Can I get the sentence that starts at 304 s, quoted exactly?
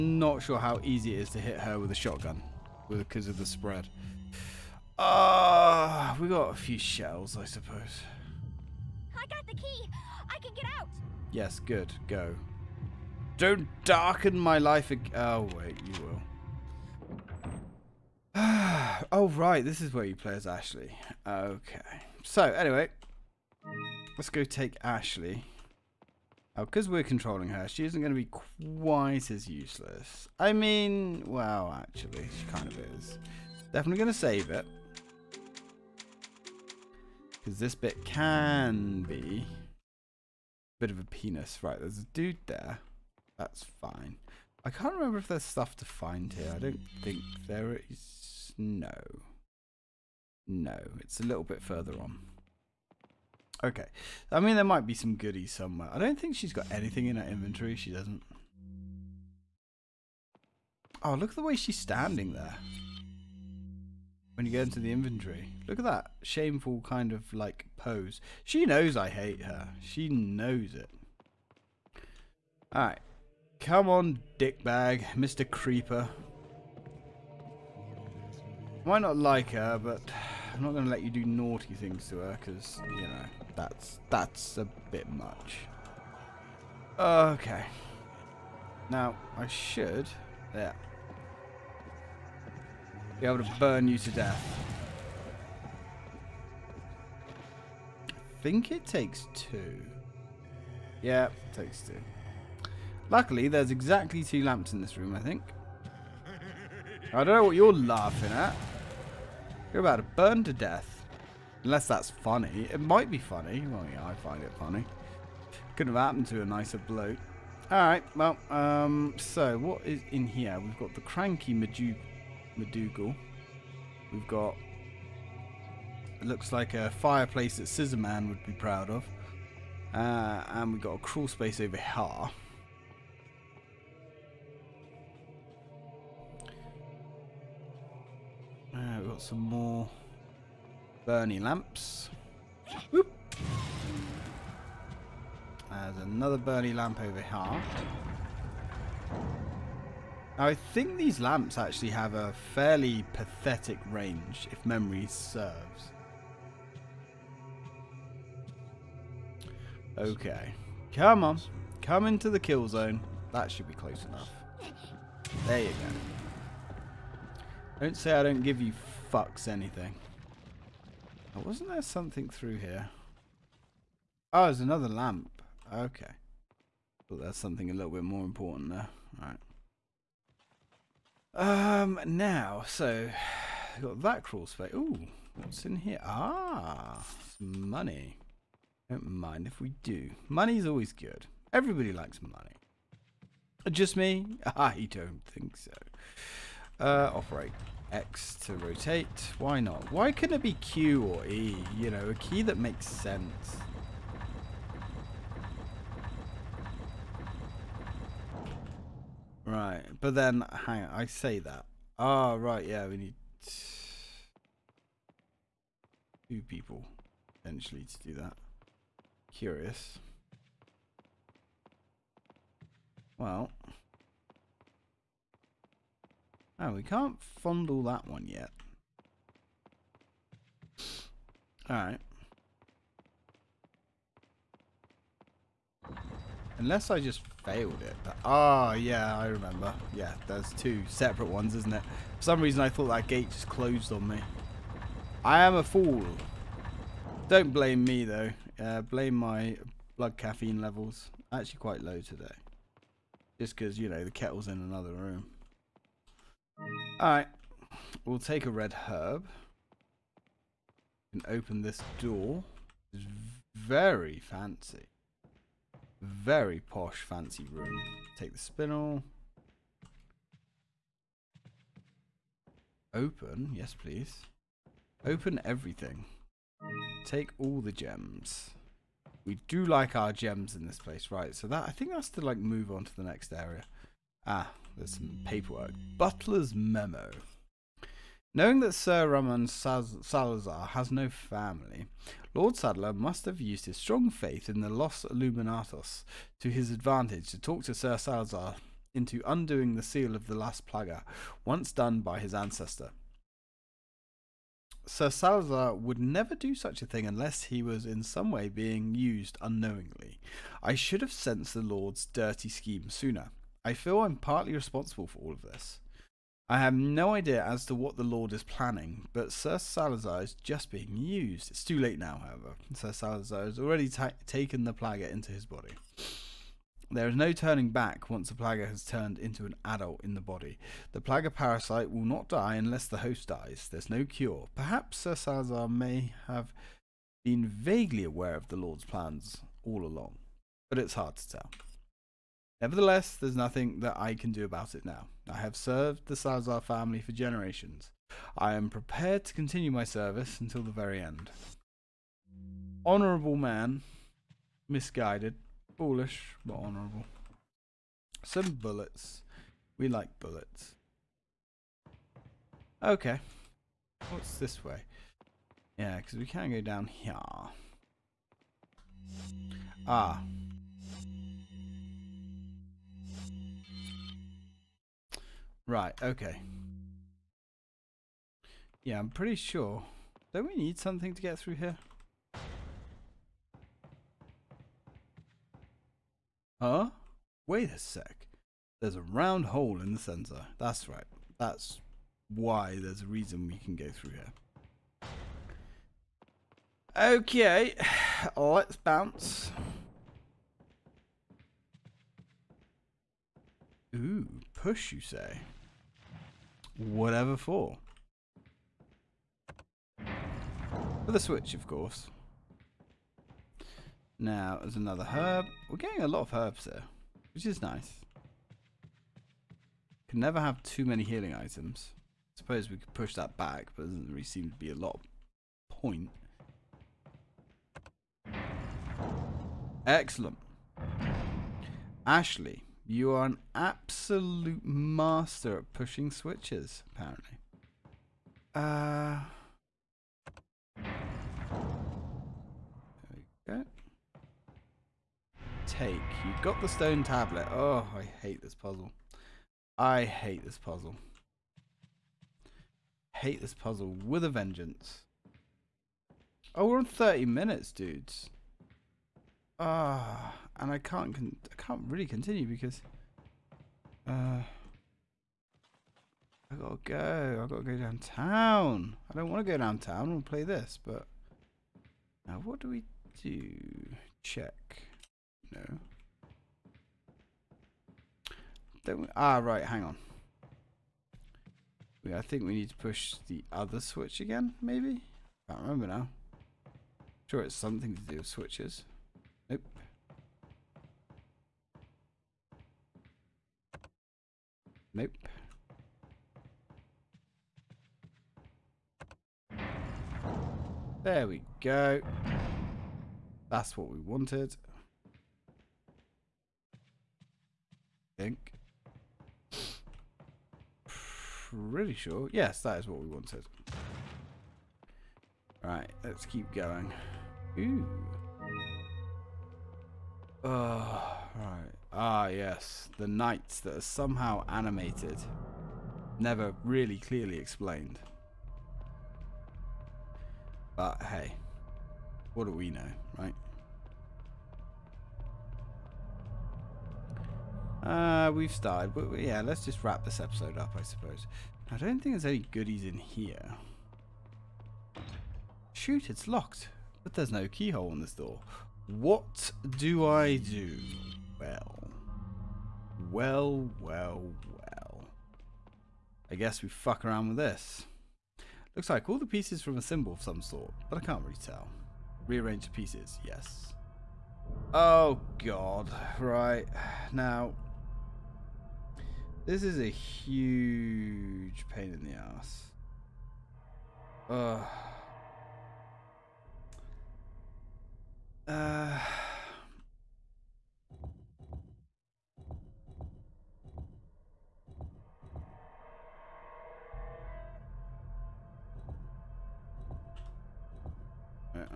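Sir Salazar would never do such a thing unless he was in some way being used unknowingly.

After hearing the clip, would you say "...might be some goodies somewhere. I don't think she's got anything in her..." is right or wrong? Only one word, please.
right.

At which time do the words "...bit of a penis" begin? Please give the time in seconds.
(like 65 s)
40 s.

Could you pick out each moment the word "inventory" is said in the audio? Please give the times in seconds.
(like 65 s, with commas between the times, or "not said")
57 s, 64 s.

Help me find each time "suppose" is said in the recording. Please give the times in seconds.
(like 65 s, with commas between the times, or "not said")
7 s, 422 s, 540 s.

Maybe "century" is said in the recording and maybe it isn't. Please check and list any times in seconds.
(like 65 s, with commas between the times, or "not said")
not said.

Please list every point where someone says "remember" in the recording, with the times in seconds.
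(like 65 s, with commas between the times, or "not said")
44 s, 239 s, 485 s.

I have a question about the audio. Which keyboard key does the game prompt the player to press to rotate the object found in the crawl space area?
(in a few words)
X.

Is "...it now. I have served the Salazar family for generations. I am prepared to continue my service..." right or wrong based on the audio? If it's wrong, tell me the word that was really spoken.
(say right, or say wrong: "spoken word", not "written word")
right.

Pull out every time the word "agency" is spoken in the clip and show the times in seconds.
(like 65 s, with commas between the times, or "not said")
not said.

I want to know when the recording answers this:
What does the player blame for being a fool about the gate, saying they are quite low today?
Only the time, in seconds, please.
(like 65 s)
249 s.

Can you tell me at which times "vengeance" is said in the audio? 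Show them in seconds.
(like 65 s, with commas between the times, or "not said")
454 s.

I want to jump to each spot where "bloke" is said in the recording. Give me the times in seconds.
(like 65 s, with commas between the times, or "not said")
116 s.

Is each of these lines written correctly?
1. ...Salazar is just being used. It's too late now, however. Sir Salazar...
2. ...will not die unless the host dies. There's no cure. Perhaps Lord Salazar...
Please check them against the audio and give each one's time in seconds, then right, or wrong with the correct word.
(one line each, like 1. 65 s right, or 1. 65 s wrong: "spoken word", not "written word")
1. 319 s right
2. 331 s wrong: "Sir", not "Lord".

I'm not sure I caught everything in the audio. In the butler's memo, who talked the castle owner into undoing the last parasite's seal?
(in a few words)
Lord Sadler.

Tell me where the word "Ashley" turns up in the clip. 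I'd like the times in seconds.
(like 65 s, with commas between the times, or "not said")
20 s, 24 s, 432 s.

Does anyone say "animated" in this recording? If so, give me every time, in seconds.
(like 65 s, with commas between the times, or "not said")
524 s.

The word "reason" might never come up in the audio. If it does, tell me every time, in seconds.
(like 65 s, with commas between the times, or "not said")
242 s, 393 s.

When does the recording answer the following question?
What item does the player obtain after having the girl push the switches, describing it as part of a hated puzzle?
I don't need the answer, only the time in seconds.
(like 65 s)
446 s.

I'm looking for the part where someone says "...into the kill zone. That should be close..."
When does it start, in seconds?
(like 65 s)
162 s.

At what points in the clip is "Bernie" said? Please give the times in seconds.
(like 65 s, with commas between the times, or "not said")
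141 s, 146 s.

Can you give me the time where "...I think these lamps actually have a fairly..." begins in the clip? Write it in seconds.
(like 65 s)
150 s.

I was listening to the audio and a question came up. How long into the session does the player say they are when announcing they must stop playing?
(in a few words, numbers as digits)
30 minutes.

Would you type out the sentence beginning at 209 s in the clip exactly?
Right, but then, hang on, I say that.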